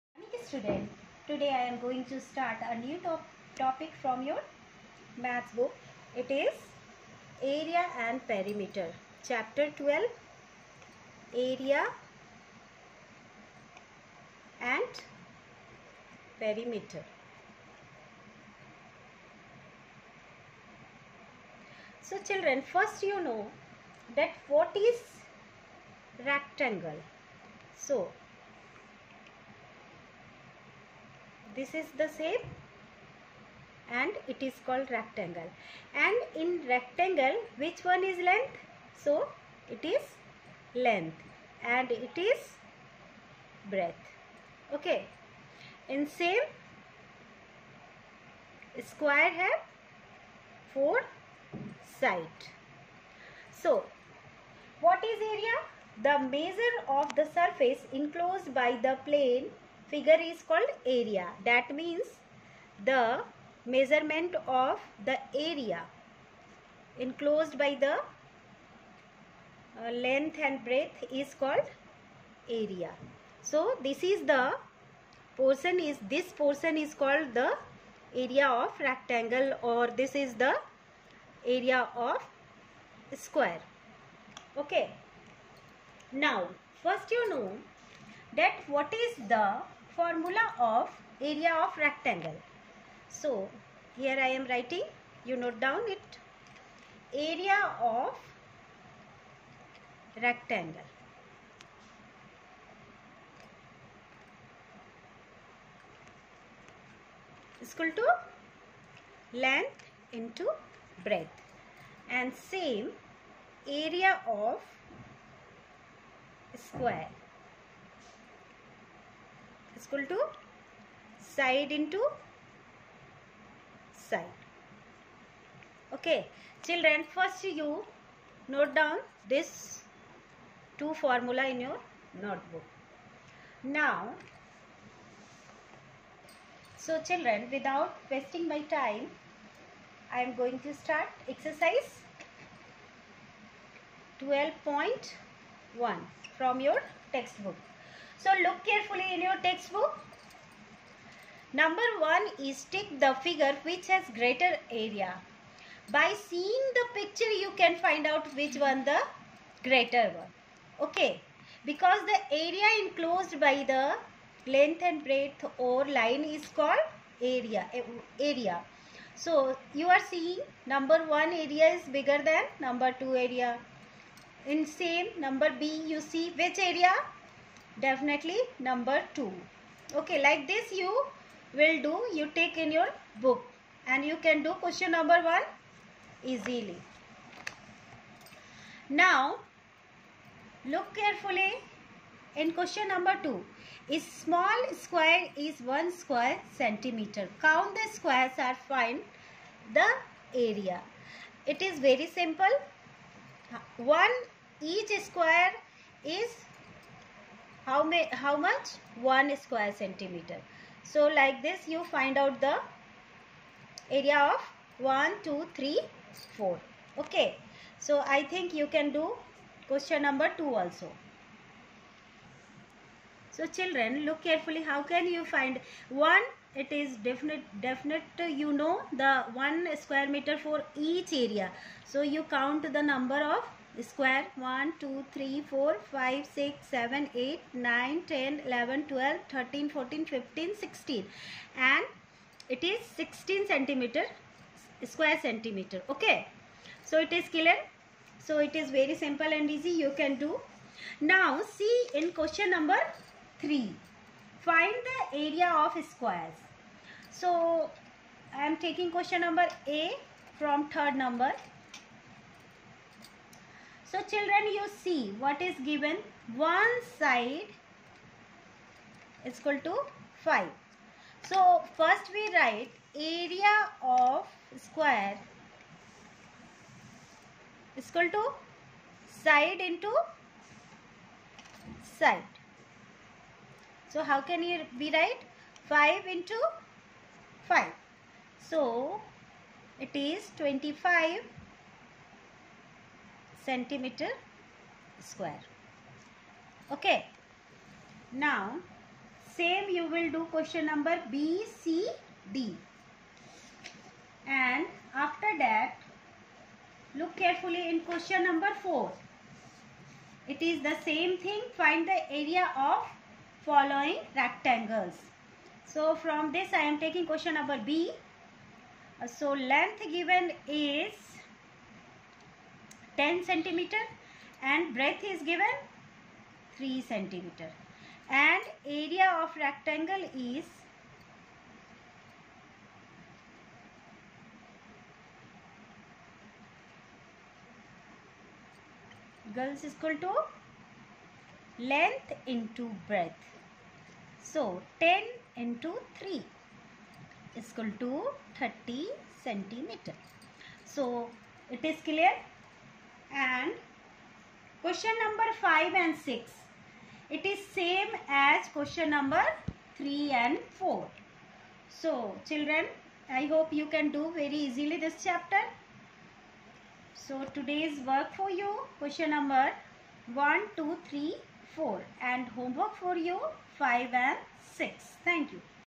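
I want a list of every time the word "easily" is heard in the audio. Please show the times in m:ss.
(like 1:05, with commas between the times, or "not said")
3:06, 6:04.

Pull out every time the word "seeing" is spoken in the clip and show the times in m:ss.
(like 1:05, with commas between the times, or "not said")
2:36, 2:50.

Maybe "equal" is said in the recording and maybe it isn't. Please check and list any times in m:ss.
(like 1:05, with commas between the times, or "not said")
1:47, 1:59, 4:29, 4:37, 5:39, 5:47.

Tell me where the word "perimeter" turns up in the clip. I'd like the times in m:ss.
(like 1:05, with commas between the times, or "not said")
0:08, 0:16.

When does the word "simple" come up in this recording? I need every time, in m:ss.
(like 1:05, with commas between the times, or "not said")
3:22, 4:09.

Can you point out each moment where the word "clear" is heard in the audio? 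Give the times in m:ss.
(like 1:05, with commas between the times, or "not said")
4:07, 5:51.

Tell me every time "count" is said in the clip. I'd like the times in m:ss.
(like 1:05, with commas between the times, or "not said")
3:17, 3:52.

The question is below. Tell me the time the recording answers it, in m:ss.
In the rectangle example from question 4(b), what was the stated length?
5:22.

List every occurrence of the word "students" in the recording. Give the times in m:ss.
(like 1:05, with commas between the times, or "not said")
0:00.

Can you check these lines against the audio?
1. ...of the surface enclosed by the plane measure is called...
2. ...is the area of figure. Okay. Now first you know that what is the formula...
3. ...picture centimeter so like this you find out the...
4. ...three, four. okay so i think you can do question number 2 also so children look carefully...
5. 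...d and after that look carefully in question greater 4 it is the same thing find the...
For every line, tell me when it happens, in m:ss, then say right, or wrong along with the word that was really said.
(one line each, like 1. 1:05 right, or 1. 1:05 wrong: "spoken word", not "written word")
1. 0:56 wrong: "figure", not "measure"
2. 1:20 wrong: "square", not "figure"
3. 3:29 wrong: "square", not "picture"
4. 3:35 right
5. 5:02 wrong: "number", not "greater".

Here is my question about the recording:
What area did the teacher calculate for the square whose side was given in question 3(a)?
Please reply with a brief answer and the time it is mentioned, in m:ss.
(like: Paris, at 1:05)
25 square centimeters, at 4:50.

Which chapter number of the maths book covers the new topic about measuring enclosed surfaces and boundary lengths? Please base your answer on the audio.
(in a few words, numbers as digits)
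12.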